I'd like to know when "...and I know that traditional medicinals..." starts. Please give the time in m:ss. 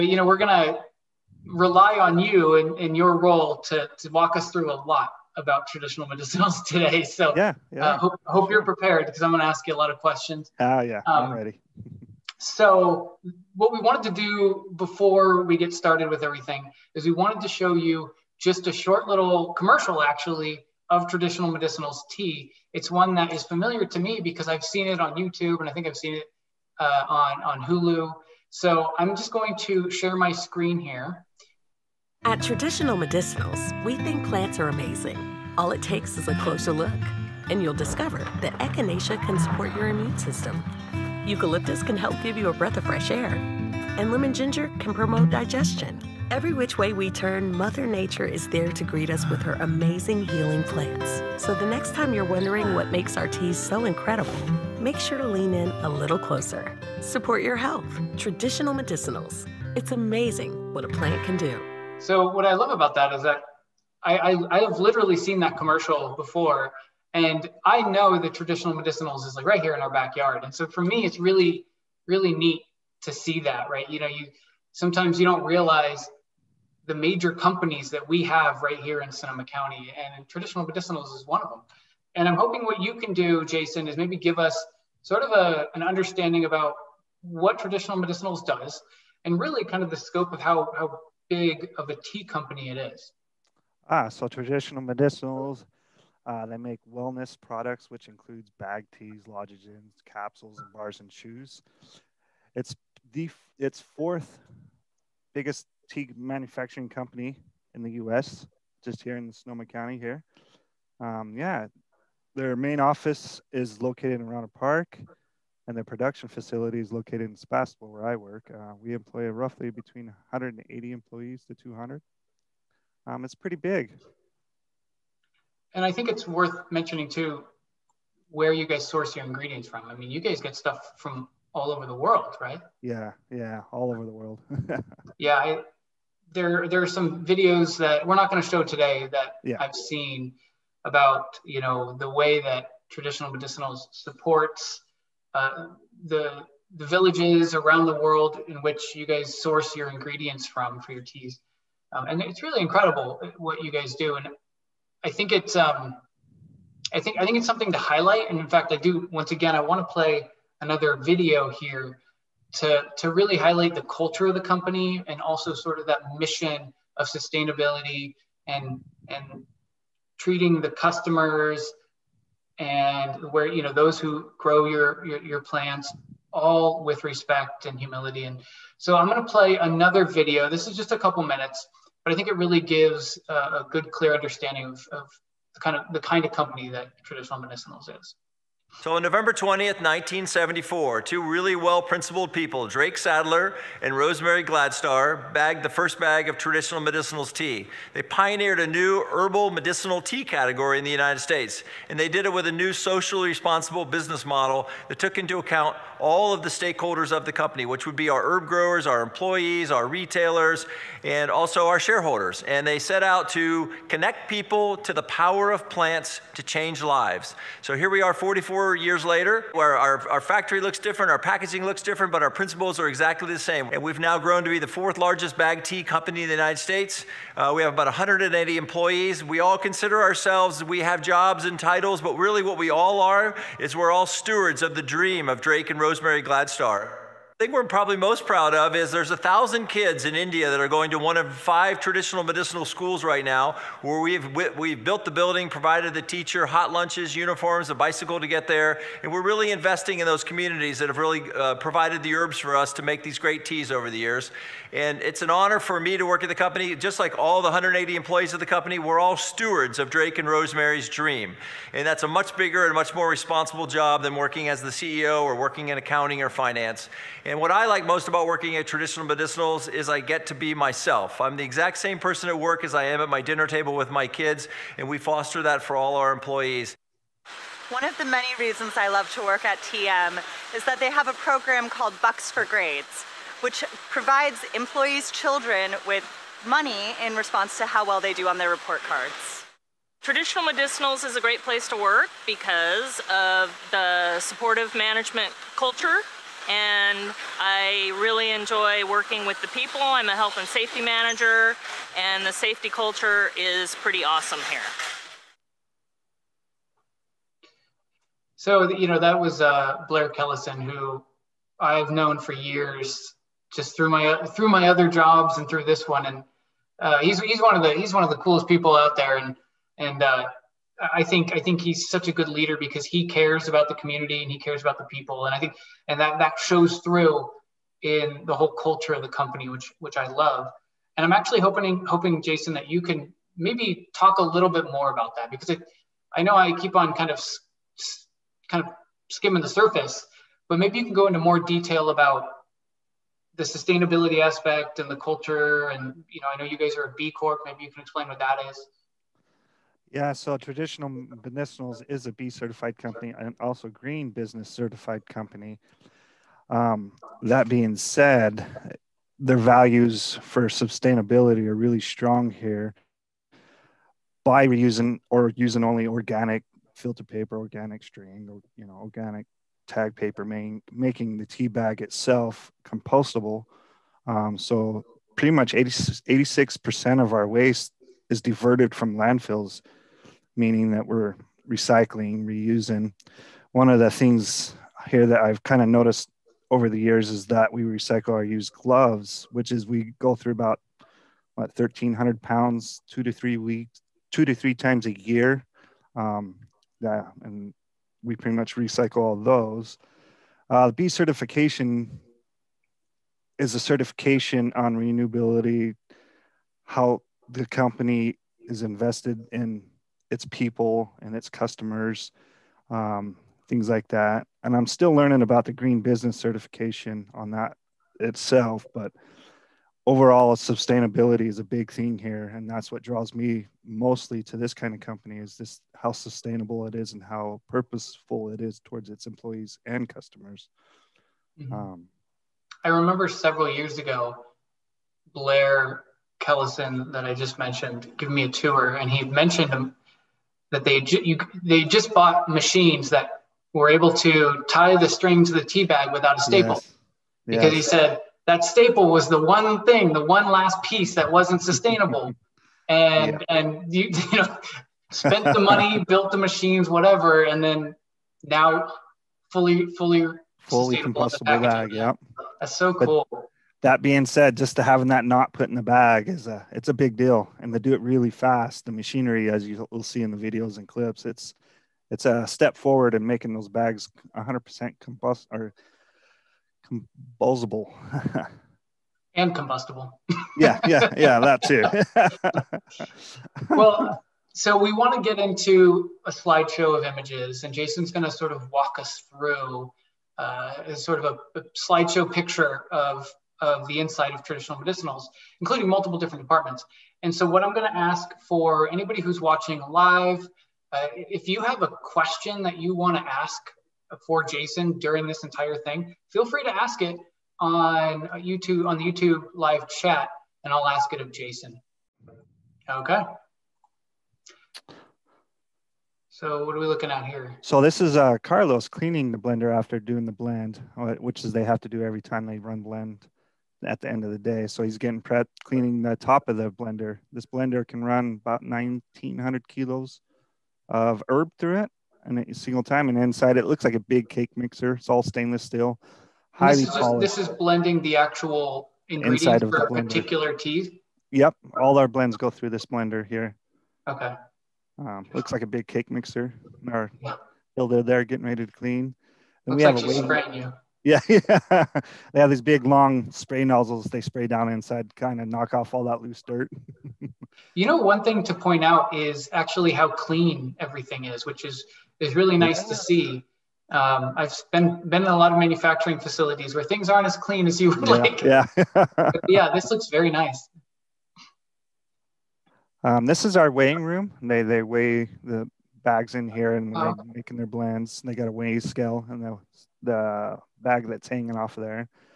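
1:07.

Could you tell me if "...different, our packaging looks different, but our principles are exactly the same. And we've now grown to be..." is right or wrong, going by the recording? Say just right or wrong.
right.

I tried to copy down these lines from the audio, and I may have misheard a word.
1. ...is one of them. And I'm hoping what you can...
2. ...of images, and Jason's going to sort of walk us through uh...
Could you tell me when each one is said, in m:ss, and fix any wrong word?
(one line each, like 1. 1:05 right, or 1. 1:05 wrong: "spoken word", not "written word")
1. 1:21 right
2. 8:06 right.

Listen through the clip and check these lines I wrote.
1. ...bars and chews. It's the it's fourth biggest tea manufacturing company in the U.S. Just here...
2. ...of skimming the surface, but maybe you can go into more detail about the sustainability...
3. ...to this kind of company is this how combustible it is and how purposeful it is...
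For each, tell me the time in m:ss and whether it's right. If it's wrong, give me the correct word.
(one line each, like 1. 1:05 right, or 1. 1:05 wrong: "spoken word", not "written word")
1. 1:40 right
2. 5:38 right
3. 7:04 wrong: "sustainable", not "combustible".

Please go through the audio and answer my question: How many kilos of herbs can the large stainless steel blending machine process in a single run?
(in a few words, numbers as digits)
1900 kilos.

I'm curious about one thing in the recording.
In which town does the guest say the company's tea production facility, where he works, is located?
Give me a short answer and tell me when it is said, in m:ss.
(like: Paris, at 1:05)
Sebastopol, at 1:57.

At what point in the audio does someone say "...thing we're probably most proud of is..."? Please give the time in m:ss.
3:57.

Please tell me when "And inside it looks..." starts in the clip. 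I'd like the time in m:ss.
8:52.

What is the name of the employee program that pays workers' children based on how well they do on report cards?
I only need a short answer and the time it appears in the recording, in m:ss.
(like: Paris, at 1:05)
Bucks for Grades, at 4:42.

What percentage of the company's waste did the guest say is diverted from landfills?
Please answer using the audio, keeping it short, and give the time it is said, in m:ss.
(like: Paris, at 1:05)
86%, at 6:15.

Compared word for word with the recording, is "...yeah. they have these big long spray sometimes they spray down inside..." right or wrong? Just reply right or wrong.
wrong.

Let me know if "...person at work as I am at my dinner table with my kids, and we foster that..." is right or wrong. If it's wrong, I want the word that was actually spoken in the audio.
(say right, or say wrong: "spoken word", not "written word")
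right.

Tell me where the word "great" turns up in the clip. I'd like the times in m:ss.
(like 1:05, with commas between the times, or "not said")
4:13, 4:51.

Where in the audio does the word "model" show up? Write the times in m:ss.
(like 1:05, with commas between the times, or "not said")
3:24.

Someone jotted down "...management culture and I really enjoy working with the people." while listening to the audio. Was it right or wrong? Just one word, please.
right.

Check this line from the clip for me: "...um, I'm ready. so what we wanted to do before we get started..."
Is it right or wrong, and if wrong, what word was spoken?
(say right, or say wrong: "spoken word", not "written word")
right.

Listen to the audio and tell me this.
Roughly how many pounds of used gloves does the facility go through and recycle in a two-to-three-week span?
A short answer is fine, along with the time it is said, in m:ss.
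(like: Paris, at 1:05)
1,300 pounds, at 6:31.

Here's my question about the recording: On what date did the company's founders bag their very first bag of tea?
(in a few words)
November 20th, 1974.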